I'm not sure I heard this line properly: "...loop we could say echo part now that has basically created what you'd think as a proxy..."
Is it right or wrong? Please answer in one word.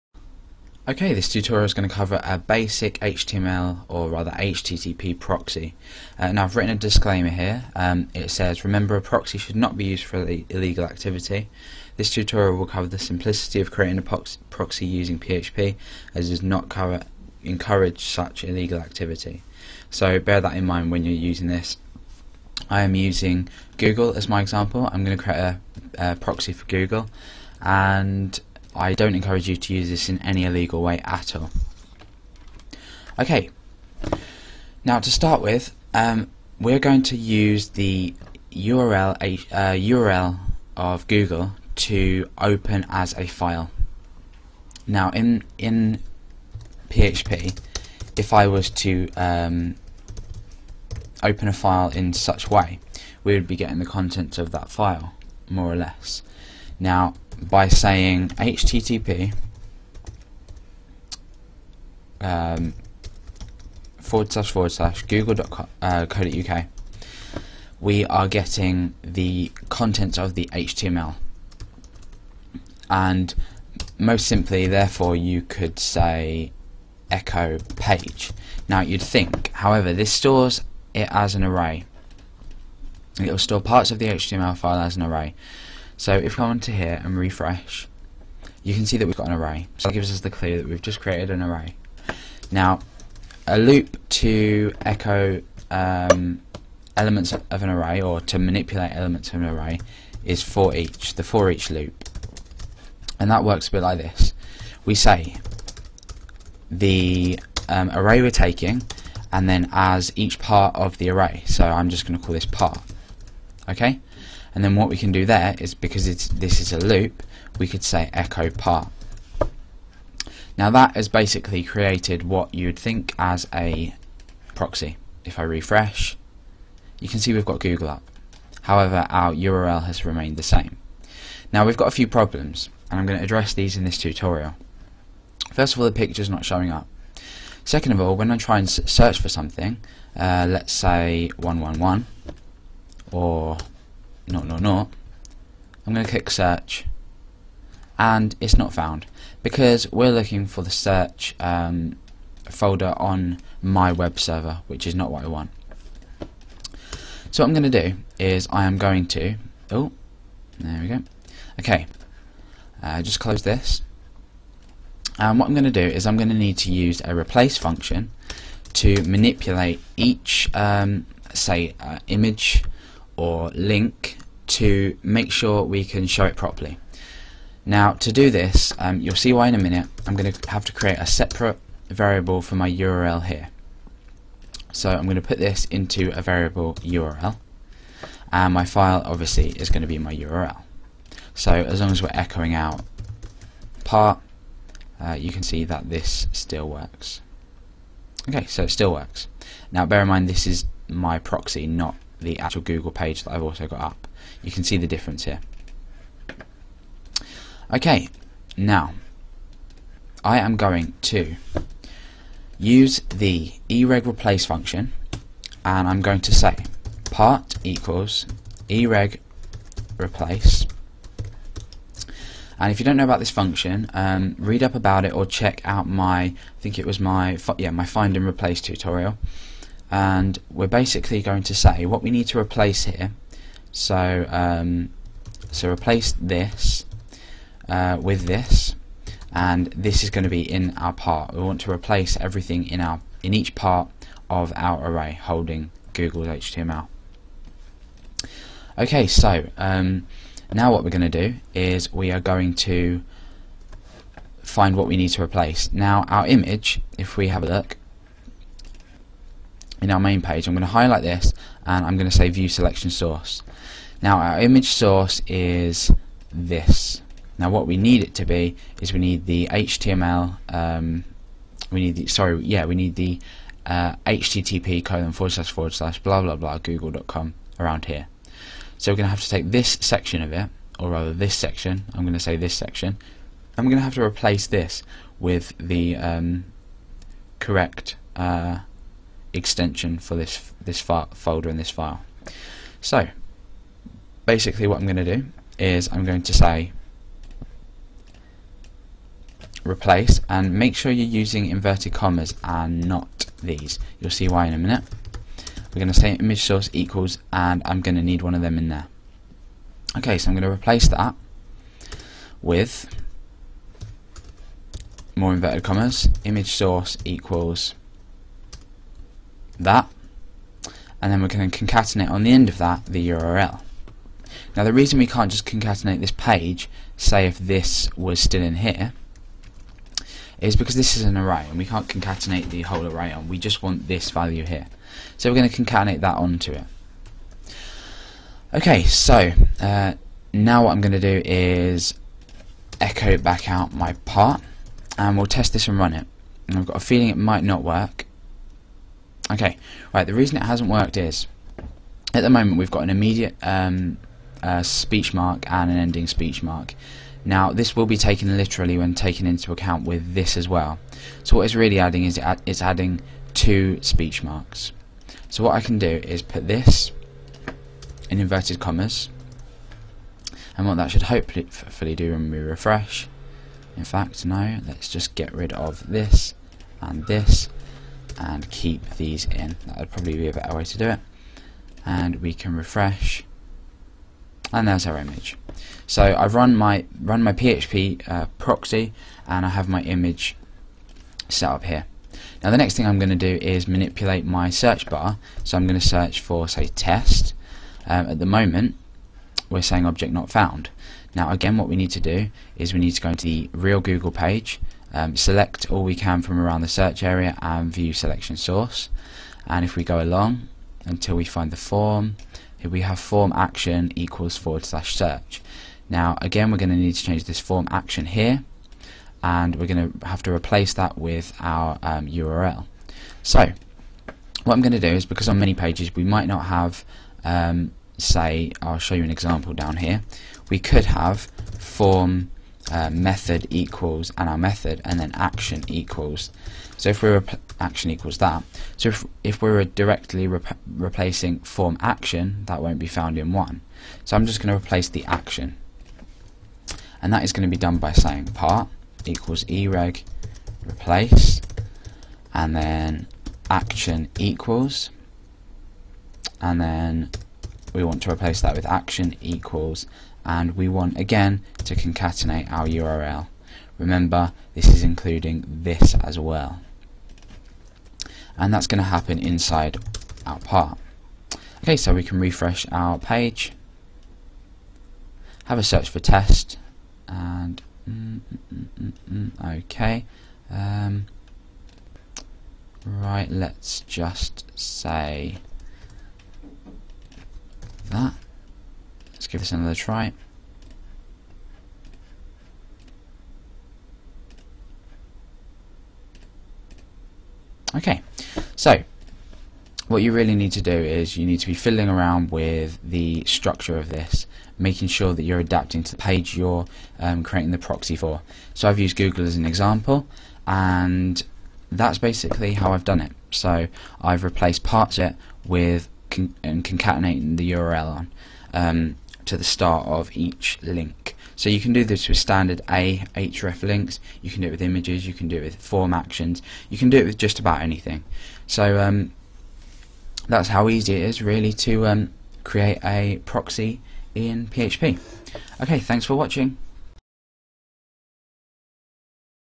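right.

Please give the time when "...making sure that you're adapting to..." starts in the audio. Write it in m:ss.
8:24.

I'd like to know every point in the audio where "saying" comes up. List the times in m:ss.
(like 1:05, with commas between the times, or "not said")
0:57, 6:39, 7:27.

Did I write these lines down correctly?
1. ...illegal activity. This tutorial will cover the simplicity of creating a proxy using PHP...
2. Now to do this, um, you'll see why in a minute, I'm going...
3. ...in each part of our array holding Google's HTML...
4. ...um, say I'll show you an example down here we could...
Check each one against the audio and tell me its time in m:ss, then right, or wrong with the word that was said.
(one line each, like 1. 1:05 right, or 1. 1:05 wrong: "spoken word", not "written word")
1. 0:10 right
2. 2:57 right
3. 4:03 right
4. 7:07 right.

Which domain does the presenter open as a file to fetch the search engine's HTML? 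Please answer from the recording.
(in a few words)
google.co.uk.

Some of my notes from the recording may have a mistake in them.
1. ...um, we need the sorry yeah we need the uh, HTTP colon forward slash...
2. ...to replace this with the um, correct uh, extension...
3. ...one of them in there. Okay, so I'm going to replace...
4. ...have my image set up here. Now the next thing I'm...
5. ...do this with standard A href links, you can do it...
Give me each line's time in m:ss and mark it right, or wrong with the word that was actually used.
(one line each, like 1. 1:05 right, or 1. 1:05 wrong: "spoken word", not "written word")
1. 4:30 right
2. 4:43 right
3. 5:08 right
4. 6:29 right
5. 8:41 right.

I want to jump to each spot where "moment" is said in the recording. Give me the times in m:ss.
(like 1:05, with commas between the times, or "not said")
5:52, 6:38.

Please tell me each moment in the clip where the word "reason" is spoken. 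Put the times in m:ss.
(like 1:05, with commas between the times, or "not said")
5:24, 5:50.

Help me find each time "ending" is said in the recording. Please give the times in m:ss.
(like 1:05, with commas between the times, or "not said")
5:55.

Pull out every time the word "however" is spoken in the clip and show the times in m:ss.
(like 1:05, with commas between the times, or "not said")
1:19, 2:08.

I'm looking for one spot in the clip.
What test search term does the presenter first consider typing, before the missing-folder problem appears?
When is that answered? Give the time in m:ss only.
2:20.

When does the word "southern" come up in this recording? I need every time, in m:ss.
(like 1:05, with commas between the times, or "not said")
not said.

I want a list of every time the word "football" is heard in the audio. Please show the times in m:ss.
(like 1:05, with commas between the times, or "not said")
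not said.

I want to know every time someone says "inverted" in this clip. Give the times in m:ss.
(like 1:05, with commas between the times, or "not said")
5:01, 5:15, 6:08.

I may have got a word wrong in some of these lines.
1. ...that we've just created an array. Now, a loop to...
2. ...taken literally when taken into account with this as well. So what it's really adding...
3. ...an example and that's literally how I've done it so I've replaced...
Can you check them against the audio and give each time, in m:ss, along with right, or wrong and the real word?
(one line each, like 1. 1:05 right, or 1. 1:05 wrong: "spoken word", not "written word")
1. 1:30 right
2. 5:57 right
3. 8:29 wrong: "basically", not "literally".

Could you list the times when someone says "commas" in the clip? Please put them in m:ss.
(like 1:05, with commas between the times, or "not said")
5:01, 5:15, 6:08.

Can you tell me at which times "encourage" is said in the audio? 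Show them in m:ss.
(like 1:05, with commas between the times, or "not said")
0:17, 0:29.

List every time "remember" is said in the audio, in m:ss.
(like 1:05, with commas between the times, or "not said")
0:08, 7:43.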